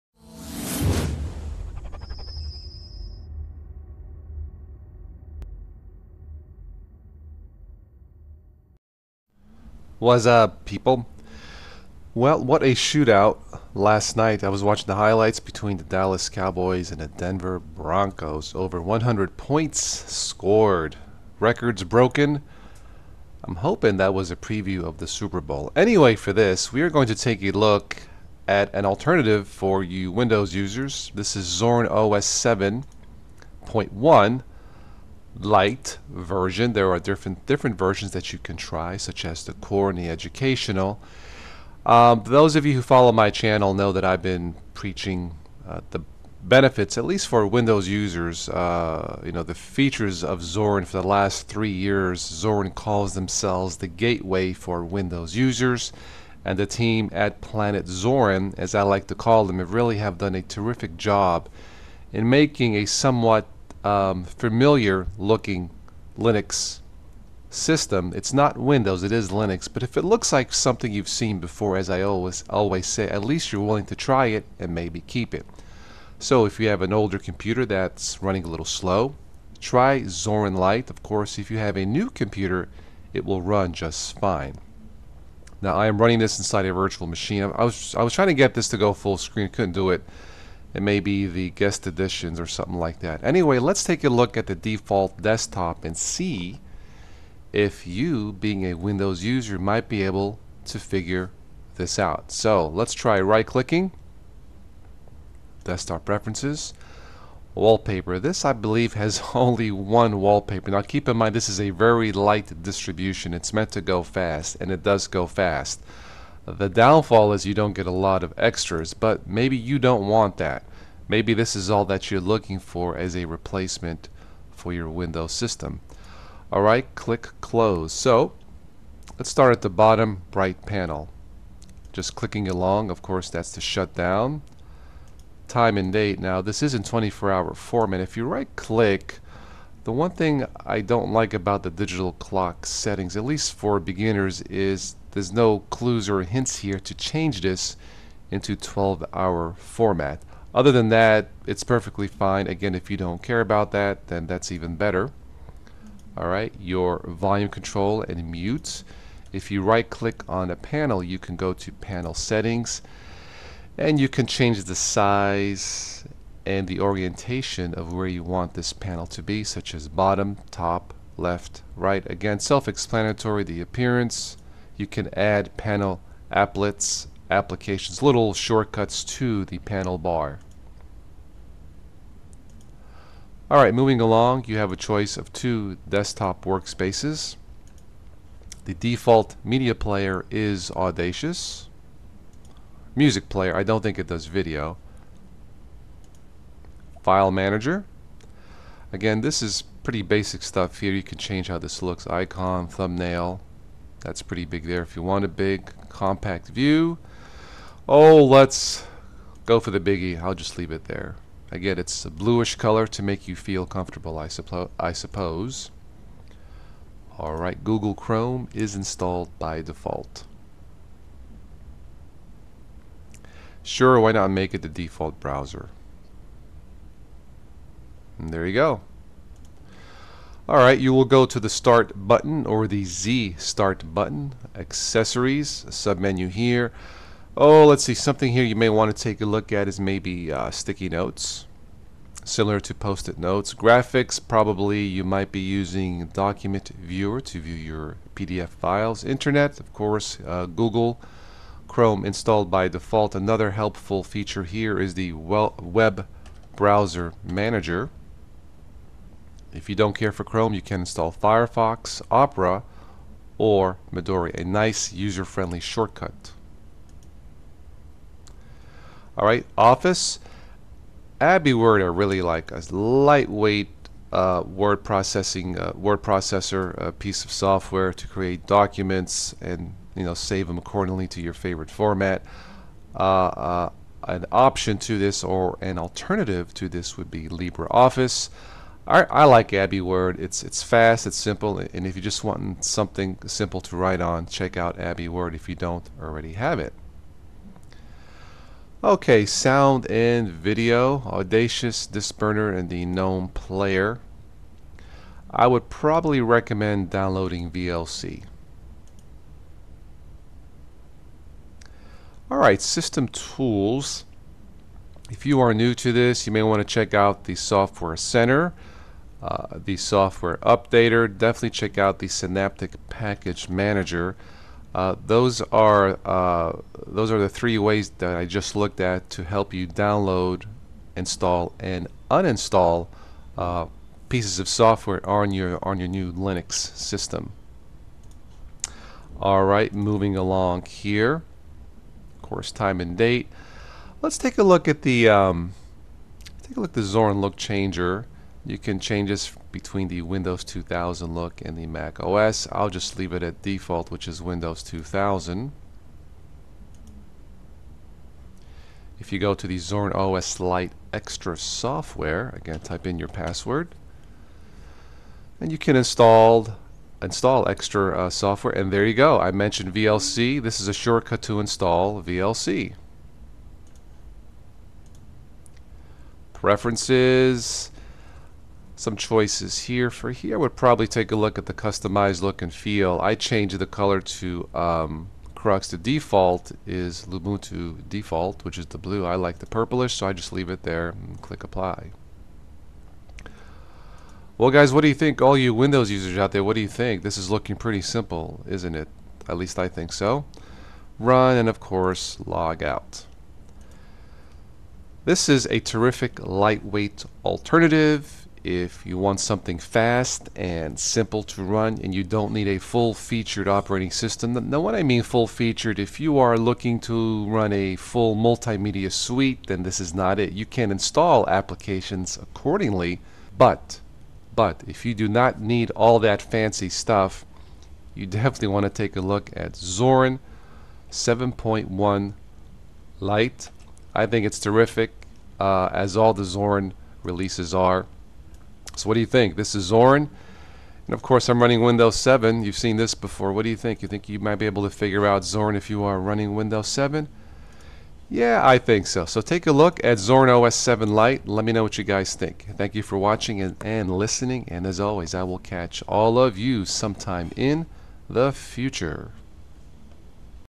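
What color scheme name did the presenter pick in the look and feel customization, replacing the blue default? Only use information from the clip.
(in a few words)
Crux.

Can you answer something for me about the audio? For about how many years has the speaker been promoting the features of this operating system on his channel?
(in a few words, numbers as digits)
3.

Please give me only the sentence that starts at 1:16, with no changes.
So if you have an older computer that's running a little slow, try Zorin Lite.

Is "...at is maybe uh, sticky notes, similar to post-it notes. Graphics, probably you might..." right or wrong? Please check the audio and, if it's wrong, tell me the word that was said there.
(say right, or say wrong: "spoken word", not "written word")
right.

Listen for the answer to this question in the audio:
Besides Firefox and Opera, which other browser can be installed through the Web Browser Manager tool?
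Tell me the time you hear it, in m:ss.
4:23.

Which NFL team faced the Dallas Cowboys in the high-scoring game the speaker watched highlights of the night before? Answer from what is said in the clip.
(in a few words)
Denver Broncos.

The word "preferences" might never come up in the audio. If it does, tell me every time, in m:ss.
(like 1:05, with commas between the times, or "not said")
1:46, 6:16.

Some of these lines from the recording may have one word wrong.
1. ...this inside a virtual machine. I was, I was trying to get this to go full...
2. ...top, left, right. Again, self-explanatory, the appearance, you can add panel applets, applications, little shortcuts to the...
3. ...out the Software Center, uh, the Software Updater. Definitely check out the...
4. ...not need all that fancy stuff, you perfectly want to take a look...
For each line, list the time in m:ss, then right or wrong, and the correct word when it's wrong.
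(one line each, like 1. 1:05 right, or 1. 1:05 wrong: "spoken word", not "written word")
1. 1:26 right
2. 2:50 right
3. 5:16 right
4. 7:05 wrong: "definitely", not "perfectly".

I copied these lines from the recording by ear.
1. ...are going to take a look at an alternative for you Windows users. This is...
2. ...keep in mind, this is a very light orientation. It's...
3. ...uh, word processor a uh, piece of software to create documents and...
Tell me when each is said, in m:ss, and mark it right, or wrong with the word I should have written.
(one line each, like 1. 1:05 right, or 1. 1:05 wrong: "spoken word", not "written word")
1. 0:26 right
2. 1:50 wrong: "distribution", not "orientation"
3. 4:35 right.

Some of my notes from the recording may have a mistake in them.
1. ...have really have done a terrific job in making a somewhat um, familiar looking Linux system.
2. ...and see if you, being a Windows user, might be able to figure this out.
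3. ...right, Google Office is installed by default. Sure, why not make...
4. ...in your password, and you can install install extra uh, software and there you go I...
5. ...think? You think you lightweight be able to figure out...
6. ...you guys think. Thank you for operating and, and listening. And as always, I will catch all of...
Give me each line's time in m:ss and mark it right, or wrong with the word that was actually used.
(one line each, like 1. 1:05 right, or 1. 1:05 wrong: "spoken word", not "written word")
1. 0:59 right
2. 1:35 right
3. 3:37 wrong: "Chrome", not "Office"
4. 6:02 right
5. 7:23 wrong: "might", not "lightweight"
6. 7:31 wrong: "watching", not "operating".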